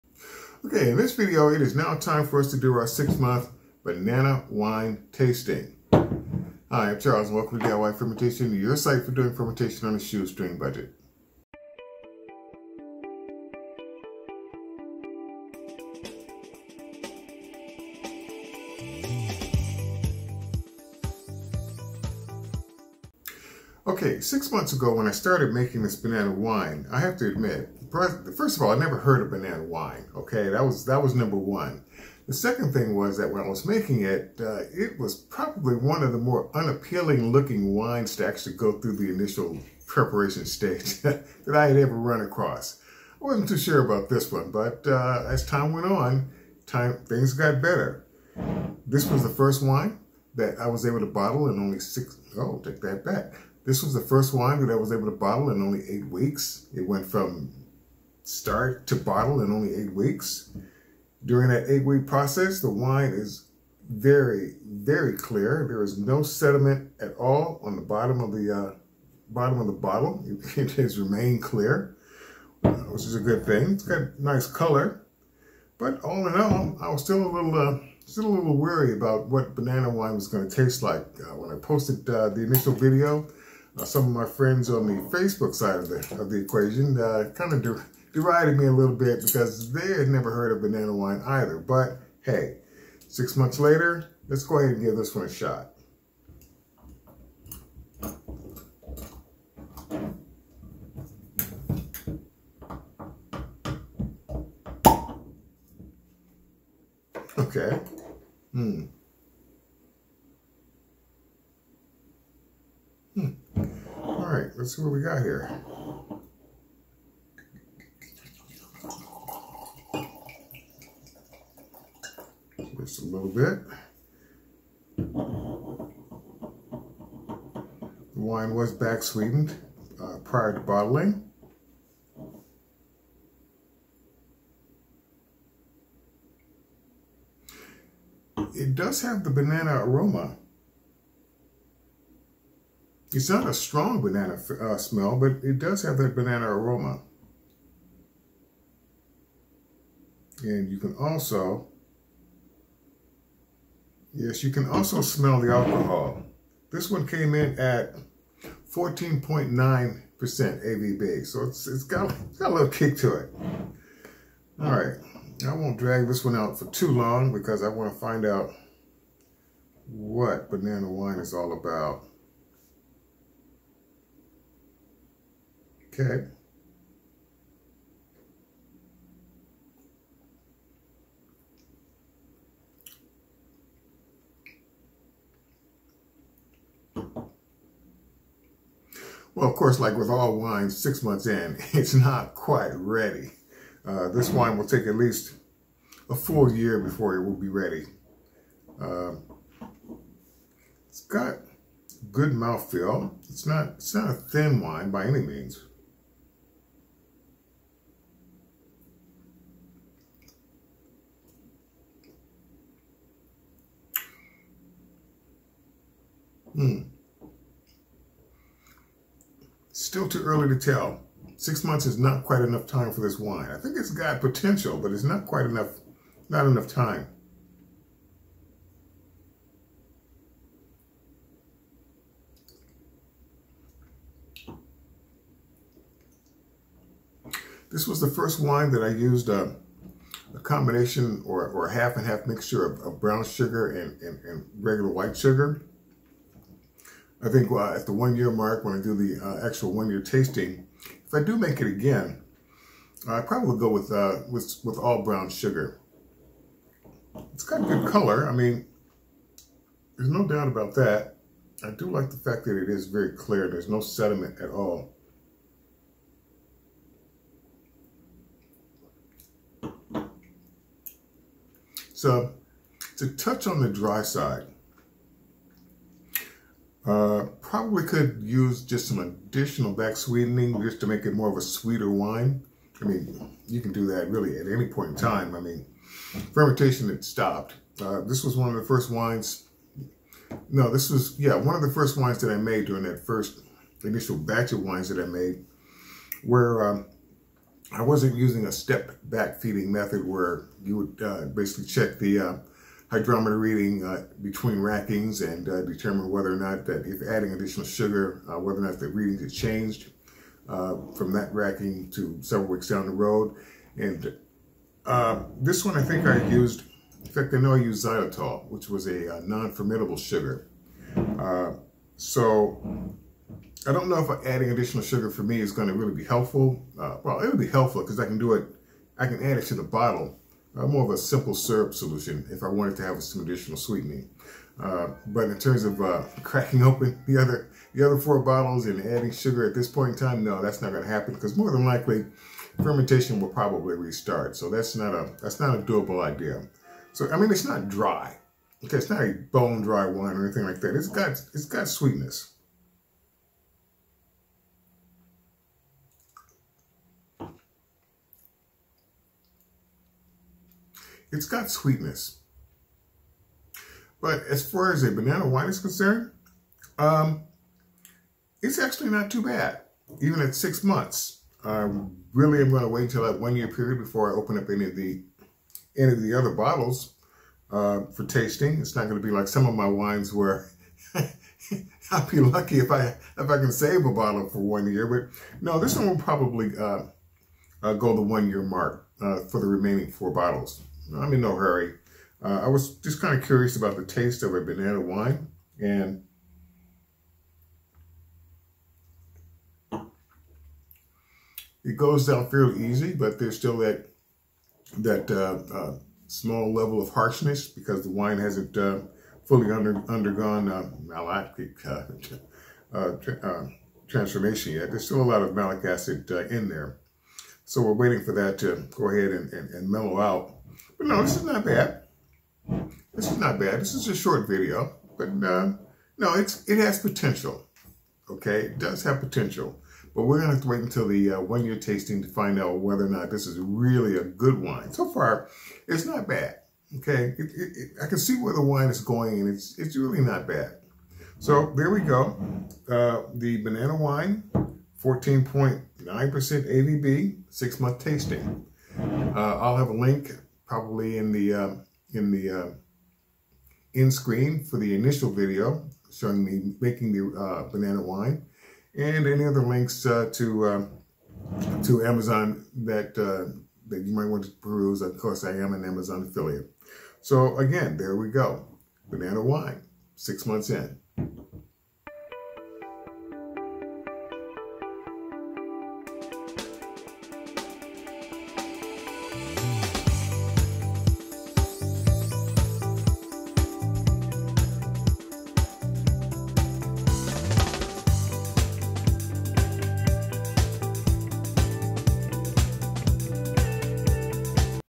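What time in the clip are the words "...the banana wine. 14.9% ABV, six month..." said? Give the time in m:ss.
7:23.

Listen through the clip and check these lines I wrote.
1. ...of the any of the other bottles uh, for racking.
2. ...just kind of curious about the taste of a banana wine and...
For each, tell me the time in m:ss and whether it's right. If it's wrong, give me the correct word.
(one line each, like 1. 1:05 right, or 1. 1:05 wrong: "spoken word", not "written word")
1. 6:14 wrong: "tasting", not "racking"
2. 6:32 right.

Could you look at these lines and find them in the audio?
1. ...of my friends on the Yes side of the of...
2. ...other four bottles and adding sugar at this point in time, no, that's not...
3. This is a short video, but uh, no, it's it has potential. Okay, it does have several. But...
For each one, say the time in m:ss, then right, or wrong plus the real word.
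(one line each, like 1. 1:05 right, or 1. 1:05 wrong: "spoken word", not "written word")
1. 1:24 wrong: "Facebook", not "Yes"
2. 5:37 right
3. 7:03 wrong: "potential", not "several".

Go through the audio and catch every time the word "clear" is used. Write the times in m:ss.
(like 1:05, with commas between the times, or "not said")
1:05, 1:11, 4:23.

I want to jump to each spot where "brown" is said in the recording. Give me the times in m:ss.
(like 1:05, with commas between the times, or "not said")
4:03, 4:15.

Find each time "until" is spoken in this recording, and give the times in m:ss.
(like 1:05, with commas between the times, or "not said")
7:10.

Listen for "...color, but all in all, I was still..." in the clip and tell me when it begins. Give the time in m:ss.
1:14.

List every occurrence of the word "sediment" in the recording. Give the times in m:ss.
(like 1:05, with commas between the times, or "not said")
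1:06, 4:23.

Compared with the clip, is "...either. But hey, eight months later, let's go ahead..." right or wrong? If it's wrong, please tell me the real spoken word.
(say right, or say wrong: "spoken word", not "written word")
wrong: "six", not "eight".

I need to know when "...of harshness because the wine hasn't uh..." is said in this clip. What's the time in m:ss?
6:46.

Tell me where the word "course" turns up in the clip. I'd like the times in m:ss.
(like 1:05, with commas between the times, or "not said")
3:09, 7:44.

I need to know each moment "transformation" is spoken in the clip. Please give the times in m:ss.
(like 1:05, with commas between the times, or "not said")
6:53.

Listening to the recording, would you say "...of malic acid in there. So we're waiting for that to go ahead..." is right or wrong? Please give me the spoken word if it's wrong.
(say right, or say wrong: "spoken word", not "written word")
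right.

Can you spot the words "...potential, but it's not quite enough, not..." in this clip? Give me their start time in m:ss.
3:44.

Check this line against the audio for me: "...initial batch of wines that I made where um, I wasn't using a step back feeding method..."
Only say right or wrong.
right.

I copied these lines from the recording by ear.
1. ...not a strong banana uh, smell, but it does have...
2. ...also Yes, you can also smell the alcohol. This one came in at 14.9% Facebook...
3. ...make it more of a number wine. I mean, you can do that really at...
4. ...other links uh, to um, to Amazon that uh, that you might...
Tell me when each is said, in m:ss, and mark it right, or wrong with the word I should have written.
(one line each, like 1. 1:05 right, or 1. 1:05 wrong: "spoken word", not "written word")
1. 2:23 right
2. 2:30 wrong: "ABV", not "Facebook"
3. 4:40 wrong: "sweeter", not "number"
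4. 7:39 right.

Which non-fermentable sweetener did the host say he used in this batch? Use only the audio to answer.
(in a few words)
xylitol.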